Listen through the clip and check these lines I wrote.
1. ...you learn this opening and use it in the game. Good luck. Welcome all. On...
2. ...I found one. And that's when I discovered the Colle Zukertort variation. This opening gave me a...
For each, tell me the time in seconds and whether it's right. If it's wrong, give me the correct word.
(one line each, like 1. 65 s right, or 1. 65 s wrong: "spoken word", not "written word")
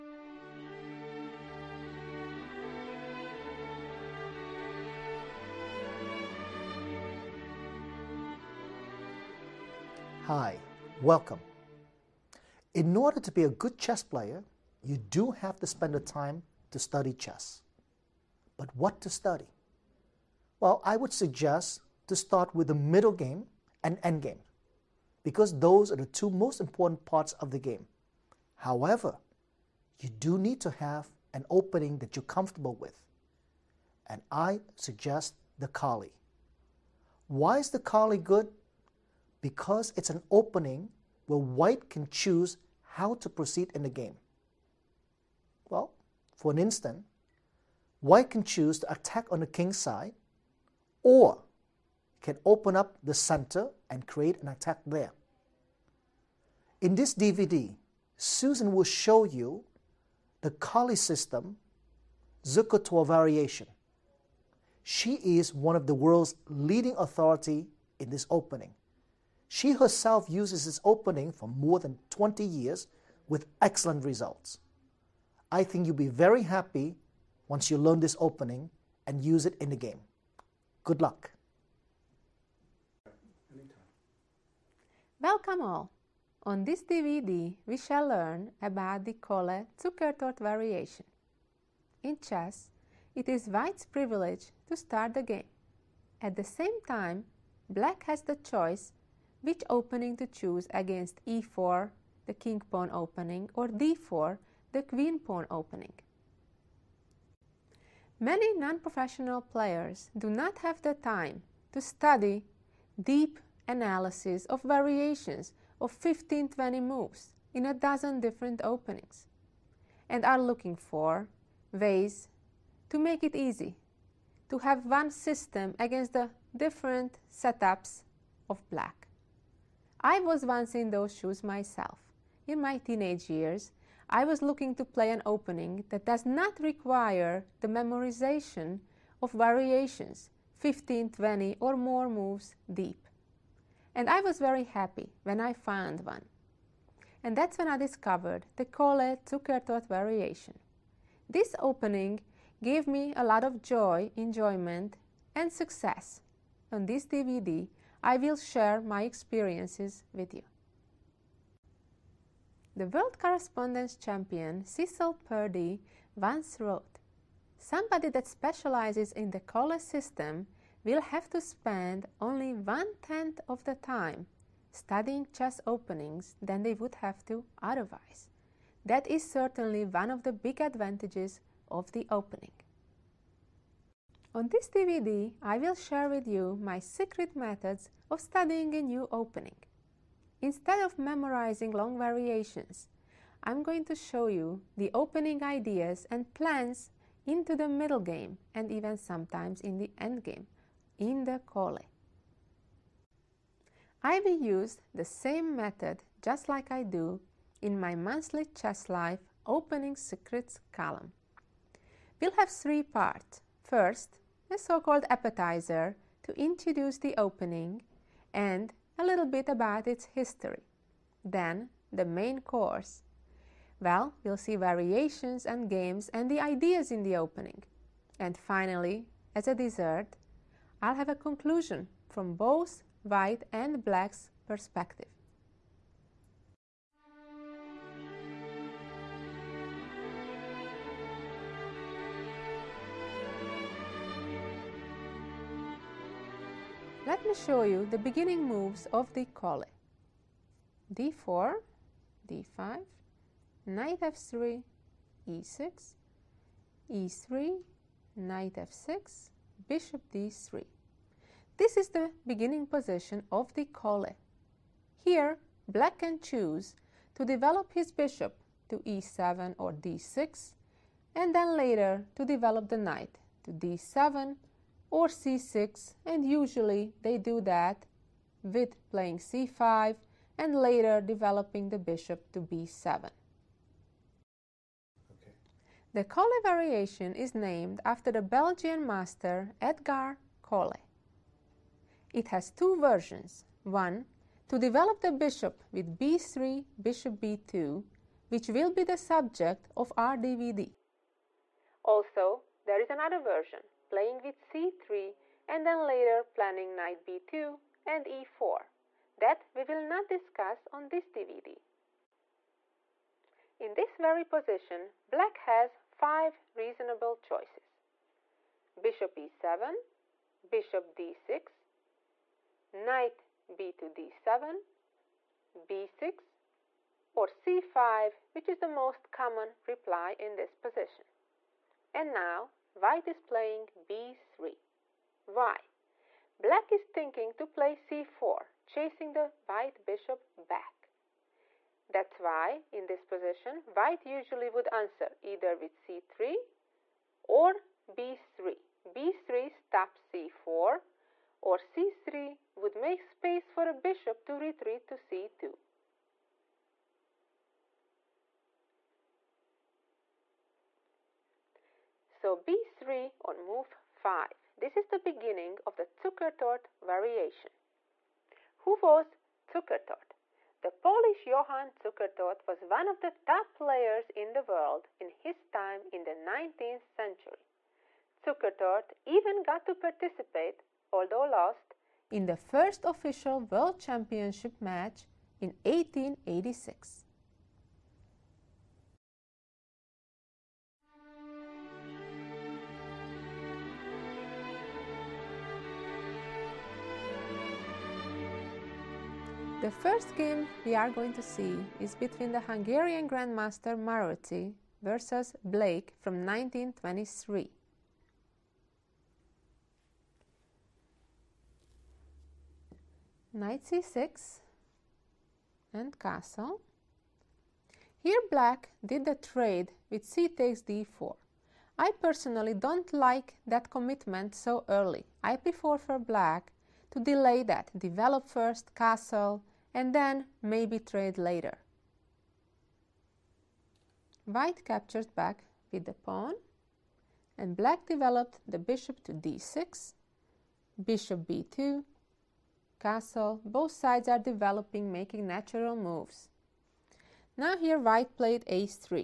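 1. 77 s right
2. 145 s right.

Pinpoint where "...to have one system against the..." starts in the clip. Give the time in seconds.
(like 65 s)
124 s.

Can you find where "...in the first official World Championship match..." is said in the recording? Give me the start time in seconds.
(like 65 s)
382 s.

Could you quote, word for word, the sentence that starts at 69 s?
She herself uses this opening for more than 20 years with excellent results.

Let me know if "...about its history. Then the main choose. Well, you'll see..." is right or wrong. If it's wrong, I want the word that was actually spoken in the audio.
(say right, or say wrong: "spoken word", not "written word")
wrong: "course", not "choose".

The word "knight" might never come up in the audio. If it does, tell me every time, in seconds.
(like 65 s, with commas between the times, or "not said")
253 s, 258 s, 272 s, 306 s, 322 s, 413 s.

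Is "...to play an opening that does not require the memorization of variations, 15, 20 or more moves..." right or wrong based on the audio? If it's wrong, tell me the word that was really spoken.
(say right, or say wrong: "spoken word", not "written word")
right.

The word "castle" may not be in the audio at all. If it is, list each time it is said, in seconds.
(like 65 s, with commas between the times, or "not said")
415 s, 428 s, 442 s.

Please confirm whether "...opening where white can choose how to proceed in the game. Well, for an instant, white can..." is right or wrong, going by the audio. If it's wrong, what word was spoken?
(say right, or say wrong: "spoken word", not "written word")
right.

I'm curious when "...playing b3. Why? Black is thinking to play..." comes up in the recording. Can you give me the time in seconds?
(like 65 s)
333 s.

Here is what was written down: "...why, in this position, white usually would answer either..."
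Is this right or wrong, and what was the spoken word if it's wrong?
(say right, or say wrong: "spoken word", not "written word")
right.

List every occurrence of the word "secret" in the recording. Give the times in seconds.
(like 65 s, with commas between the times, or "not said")
186 s, 209 s.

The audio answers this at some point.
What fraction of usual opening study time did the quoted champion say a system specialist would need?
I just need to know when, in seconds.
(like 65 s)
172 s.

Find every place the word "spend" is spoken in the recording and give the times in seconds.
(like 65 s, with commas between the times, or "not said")
15 s, 171 s.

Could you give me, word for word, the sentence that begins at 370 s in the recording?
The Polish Johann Zukertort was one of the top players in the world in his time in the 19th century.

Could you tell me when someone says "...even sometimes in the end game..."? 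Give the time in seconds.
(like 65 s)
198 s.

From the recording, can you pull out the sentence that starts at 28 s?
However, you do need to have an opening that you're comfortable with.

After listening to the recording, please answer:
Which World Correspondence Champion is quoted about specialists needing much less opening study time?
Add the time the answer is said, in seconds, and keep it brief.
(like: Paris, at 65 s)
Cecil Purdy, at 164 s.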